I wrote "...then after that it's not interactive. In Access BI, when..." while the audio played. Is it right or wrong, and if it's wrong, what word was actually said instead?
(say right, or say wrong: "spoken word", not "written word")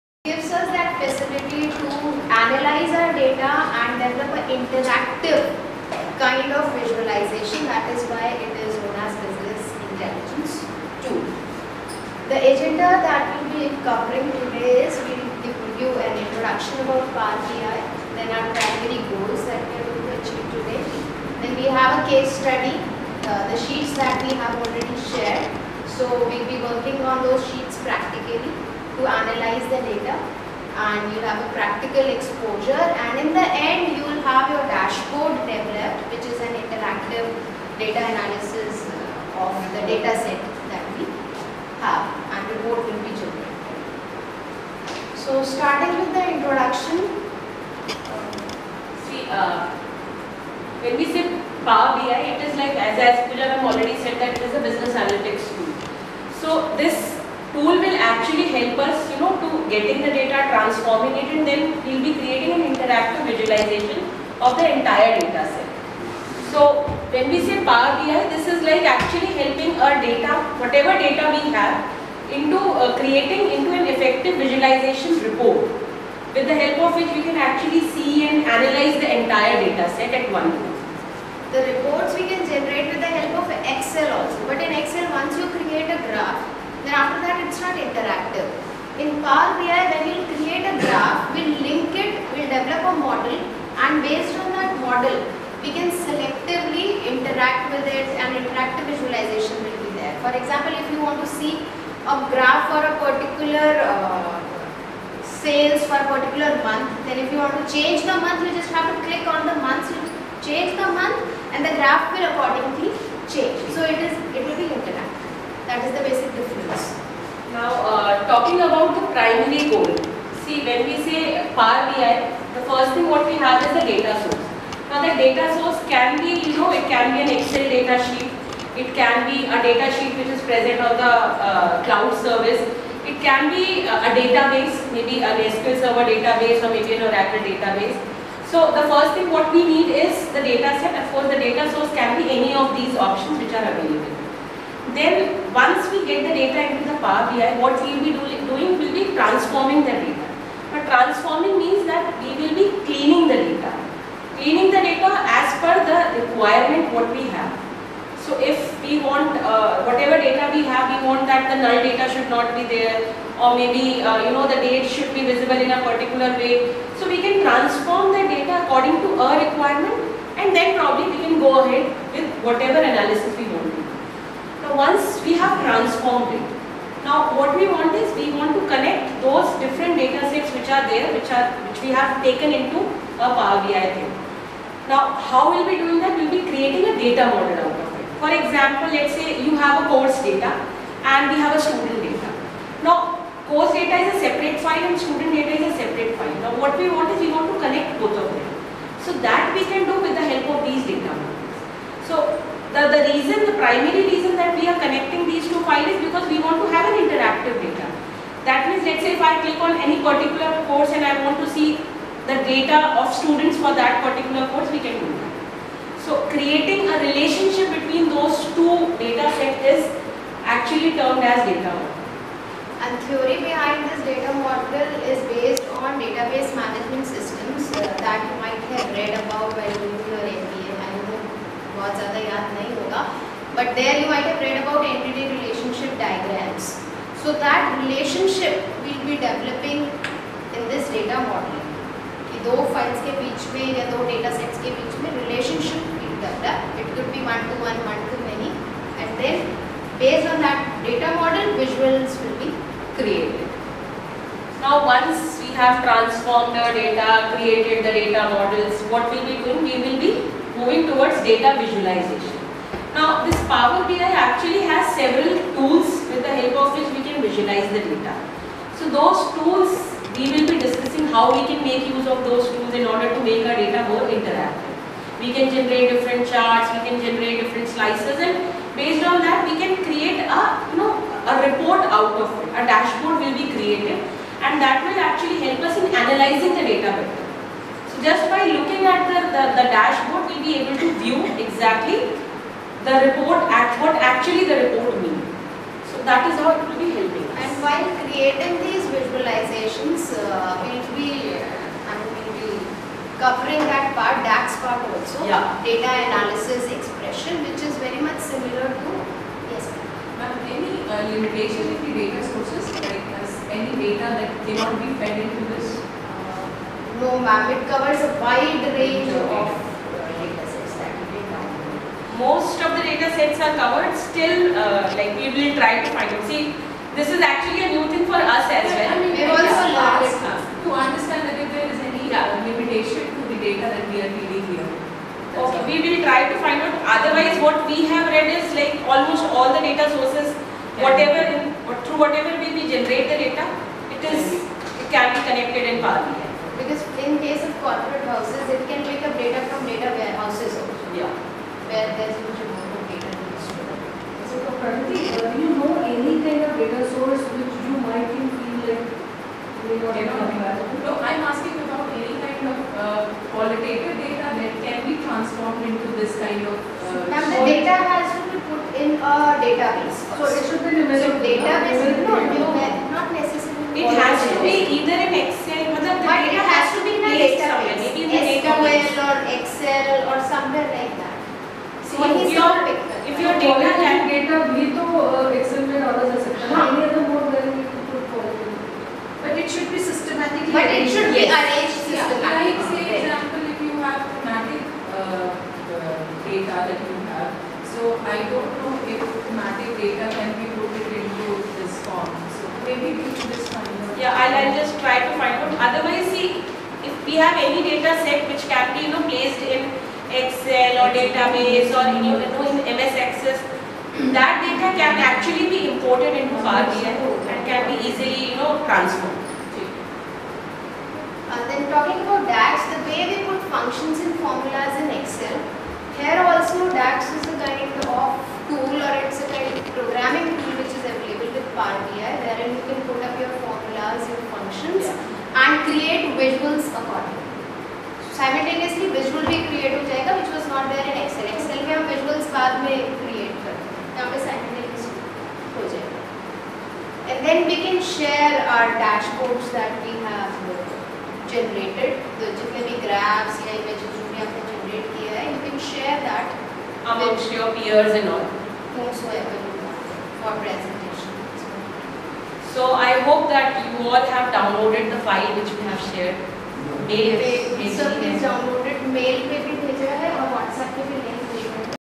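wrong: "Power", not "Access".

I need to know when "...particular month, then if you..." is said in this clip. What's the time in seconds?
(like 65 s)
106 s.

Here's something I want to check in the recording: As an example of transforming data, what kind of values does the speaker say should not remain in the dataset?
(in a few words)
null data.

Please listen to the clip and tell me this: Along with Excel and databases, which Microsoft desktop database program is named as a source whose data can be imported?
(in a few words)
MS Access.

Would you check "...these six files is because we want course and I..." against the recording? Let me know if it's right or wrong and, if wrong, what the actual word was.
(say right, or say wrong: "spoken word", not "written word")
wrong: "two", not "six".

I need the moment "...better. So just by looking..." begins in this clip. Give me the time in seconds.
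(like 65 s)
286 s.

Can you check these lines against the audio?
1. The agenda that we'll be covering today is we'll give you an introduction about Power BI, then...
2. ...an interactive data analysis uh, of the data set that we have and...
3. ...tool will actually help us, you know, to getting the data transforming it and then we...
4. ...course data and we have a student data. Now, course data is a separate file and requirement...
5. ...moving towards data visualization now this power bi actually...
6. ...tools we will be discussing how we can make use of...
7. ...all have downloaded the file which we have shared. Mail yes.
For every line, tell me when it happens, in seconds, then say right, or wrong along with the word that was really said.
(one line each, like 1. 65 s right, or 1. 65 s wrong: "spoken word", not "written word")
1. 12 s right
2. 36 s right
3. 57 s right
4. 189 s wrong: "student", not "requirement"
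5. 260 s right
6. 269 s right
7. 463 s right.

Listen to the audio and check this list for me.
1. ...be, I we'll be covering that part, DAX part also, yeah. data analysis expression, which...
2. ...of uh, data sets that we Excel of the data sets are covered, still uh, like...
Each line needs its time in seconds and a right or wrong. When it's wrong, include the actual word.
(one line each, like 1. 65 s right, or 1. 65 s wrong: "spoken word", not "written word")
1. 300 s right
2. 319 s wrong: "Most", not "Excel".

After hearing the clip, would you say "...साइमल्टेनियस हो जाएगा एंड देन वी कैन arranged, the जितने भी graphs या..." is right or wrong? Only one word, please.
wrong.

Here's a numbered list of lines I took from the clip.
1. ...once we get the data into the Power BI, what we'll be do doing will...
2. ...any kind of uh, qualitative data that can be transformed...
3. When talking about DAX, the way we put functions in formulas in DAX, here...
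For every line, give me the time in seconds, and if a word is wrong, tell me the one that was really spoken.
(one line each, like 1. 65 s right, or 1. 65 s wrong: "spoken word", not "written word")
1. 145 s right
2. 361 s right
3. 421 s wrong: "Excel", not "DAX".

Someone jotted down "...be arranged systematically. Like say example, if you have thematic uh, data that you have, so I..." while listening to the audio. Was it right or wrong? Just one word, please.
right.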